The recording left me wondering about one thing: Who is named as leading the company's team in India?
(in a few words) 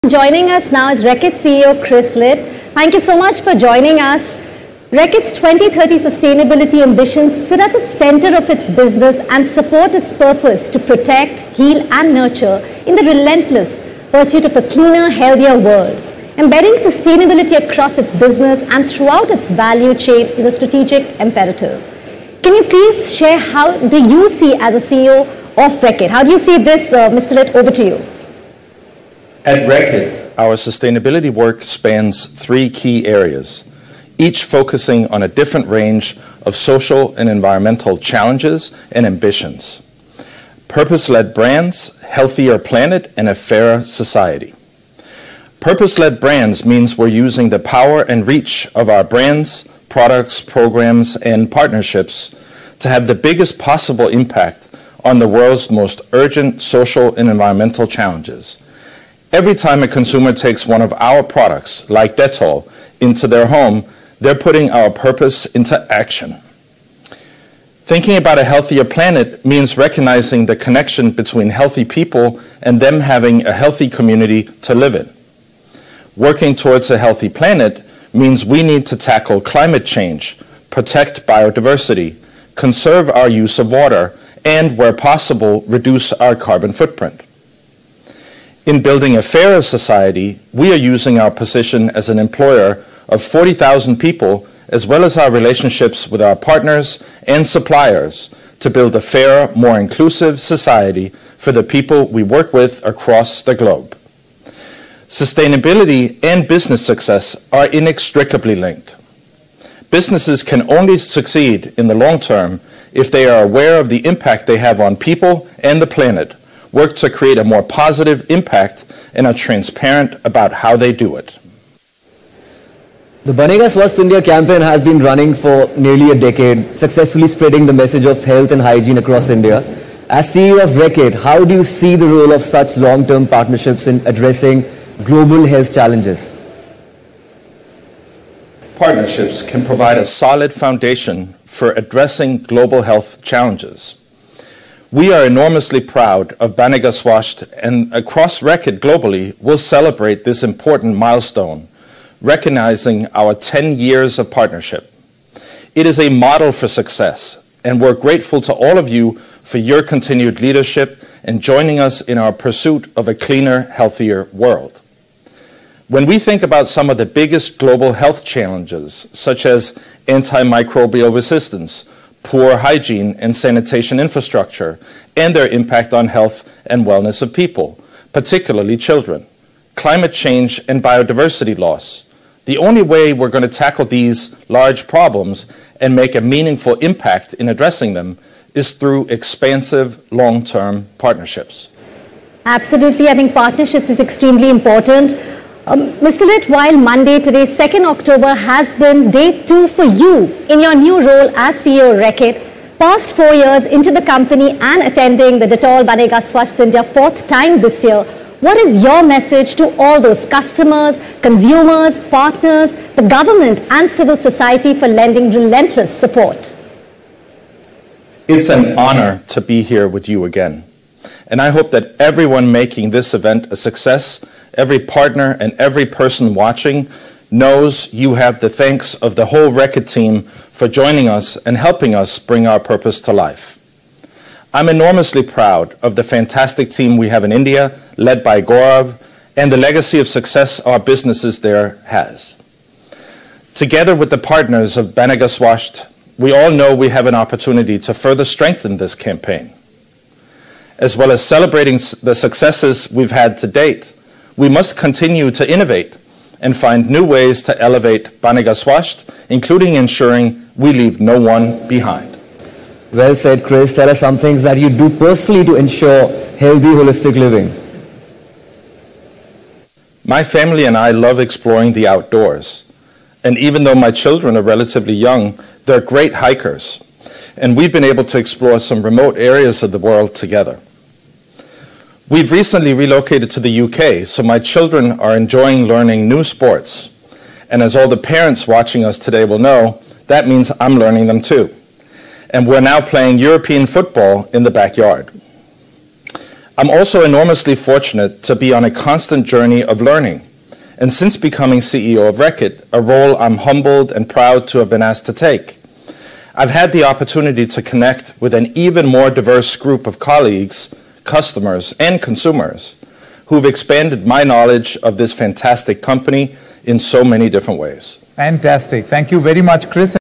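Gaurav.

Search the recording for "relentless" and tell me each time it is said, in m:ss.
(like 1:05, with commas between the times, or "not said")
0:13, 3:35.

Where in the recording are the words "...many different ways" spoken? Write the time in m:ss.
5:17.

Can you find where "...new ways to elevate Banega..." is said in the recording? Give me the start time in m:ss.
4:16.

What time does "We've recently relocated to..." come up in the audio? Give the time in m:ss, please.
4:42.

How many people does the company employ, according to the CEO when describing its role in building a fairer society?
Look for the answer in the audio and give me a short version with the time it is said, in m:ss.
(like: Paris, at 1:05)
40,000, at 1:33.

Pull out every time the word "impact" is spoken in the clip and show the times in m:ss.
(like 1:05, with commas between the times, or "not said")
0:54, 1:54, 1:58, 2:55, 3:06.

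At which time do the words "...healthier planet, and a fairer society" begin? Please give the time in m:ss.
0:42.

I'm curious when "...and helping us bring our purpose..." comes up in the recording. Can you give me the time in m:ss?
3:51.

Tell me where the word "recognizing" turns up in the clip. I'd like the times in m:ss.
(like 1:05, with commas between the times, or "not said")
1:09, 2:32.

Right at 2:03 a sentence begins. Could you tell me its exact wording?
The Banega Swasth India campaign has been running for nearly a decade, successfully spreading the message of health and hygiene across India.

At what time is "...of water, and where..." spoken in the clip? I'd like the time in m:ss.
1:23.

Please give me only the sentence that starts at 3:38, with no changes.
It's an honor to be here with you again.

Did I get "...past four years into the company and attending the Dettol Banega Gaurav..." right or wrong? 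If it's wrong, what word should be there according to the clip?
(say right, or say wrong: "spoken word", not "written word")
wrong: "Swasth", not "Gaurav".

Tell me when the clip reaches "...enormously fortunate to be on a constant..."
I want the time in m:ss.
4:57.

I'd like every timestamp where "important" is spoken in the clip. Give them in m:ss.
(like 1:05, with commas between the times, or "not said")
2:30, 3:14.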